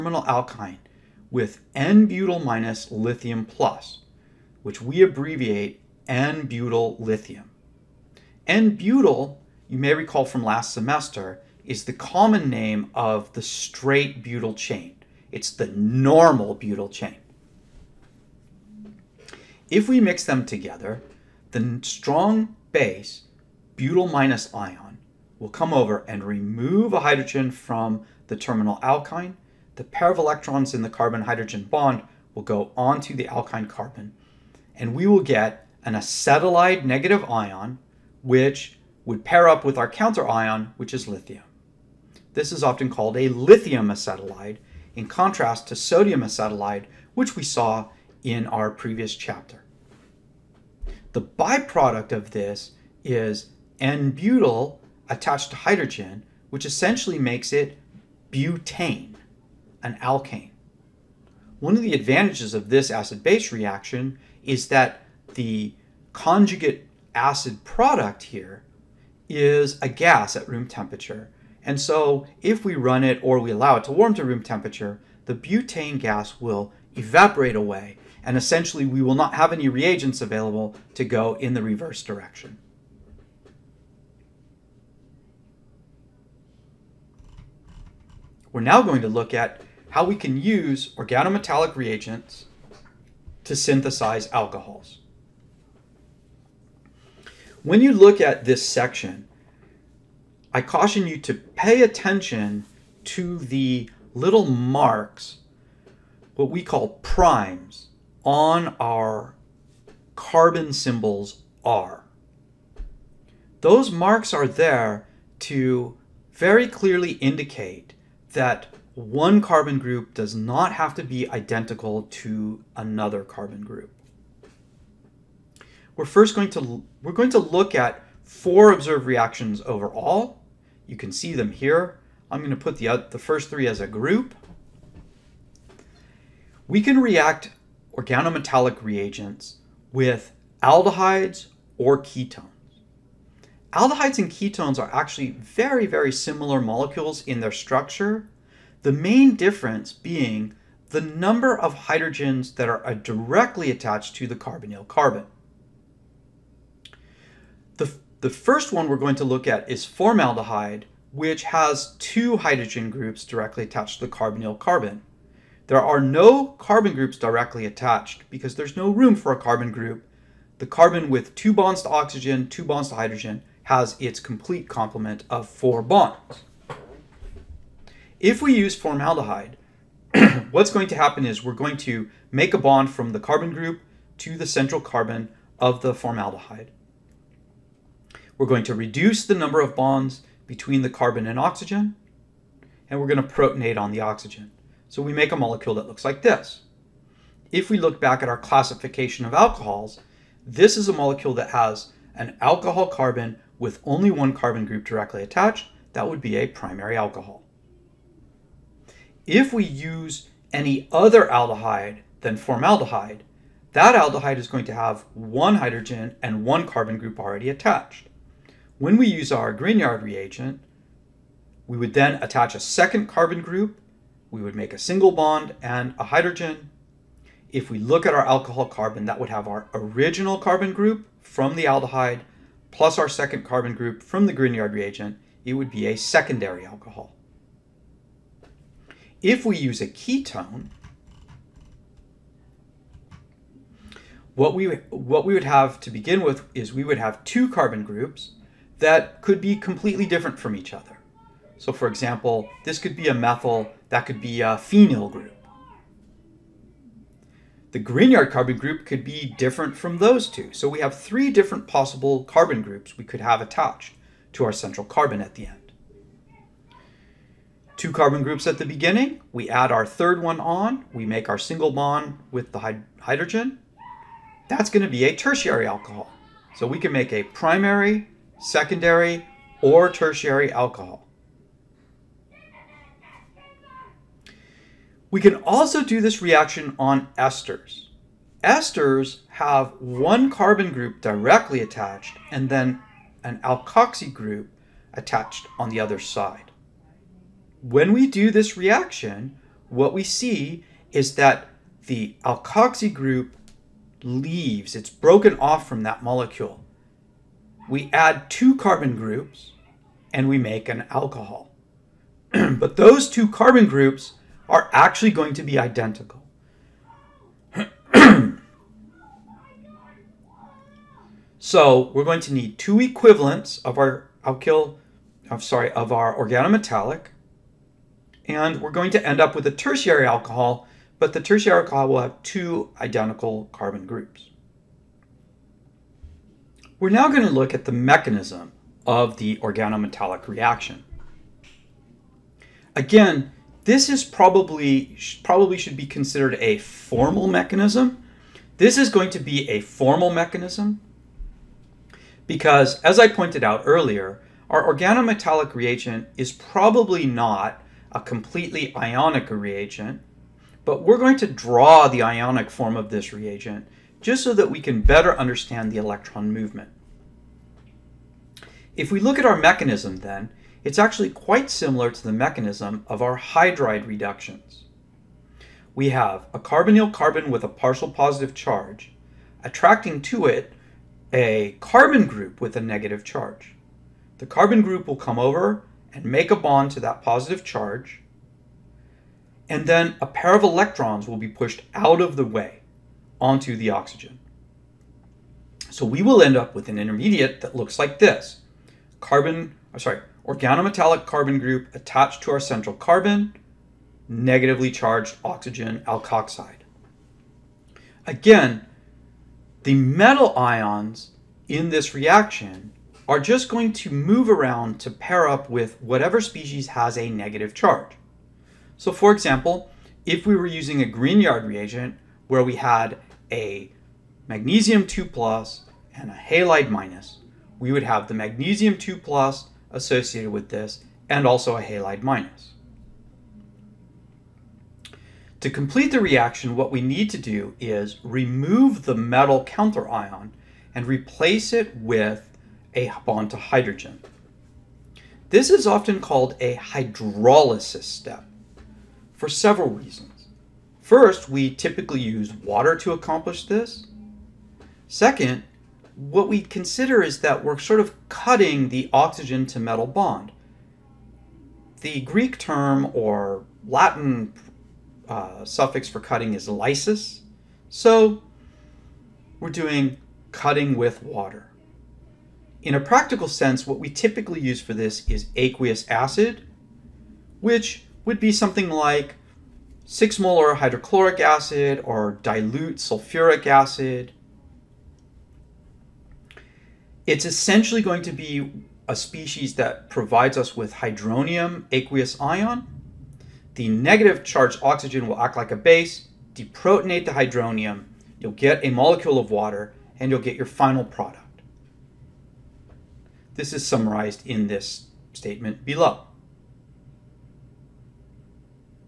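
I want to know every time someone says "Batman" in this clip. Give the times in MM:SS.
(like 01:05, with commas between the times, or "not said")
not said.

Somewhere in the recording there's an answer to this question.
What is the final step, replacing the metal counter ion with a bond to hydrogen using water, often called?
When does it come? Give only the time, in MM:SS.
07:26.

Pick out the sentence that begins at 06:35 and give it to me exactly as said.
So we will end up with an intermediate that looks like this.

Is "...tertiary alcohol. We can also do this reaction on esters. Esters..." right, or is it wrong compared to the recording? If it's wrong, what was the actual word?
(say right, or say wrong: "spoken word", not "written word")
right.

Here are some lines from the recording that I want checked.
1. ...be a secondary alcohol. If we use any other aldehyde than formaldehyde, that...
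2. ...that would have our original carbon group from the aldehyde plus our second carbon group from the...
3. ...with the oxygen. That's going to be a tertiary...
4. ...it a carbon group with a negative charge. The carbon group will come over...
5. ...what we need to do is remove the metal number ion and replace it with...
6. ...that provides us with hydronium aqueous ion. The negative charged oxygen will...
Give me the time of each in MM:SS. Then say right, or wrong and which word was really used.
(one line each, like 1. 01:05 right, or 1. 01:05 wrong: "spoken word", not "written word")
1. 03:26 wrong: "primary", not "secondary"
2. 03:49 right
3. 04:32 wrong: "hydrogen", not "oxygen"
4. 06:20 right
5. 07:16 wrong: "counter", not "number"
6. 08:09 right.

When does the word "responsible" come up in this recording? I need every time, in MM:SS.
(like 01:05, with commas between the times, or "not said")
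not said.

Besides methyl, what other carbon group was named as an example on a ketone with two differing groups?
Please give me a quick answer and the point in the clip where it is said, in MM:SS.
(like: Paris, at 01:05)
Phenyl, at 04:14.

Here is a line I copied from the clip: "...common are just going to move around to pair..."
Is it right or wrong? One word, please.
wrong.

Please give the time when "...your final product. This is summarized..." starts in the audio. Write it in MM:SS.
08:20.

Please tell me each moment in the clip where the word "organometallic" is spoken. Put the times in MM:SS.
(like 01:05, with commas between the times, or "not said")
01:30, 02:17, 05:26, 05:39, 05:54, 06:40.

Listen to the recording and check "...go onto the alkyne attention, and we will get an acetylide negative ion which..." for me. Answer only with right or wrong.
wrong.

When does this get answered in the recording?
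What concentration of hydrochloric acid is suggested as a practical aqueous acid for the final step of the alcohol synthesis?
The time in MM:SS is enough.
07:59.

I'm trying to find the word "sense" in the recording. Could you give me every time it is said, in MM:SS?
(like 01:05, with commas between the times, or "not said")
07:53.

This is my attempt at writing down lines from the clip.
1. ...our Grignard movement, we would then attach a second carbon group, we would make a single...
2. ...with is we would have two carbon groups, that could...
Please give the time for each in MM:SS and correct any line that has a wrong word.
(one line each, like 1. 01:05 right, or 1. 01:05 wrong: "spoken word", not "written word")
1. 03:39 wrong: "reagent", not "movement"
2. 04:06 right.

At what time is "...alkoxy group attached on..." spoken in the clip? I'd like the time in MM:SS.
04:53.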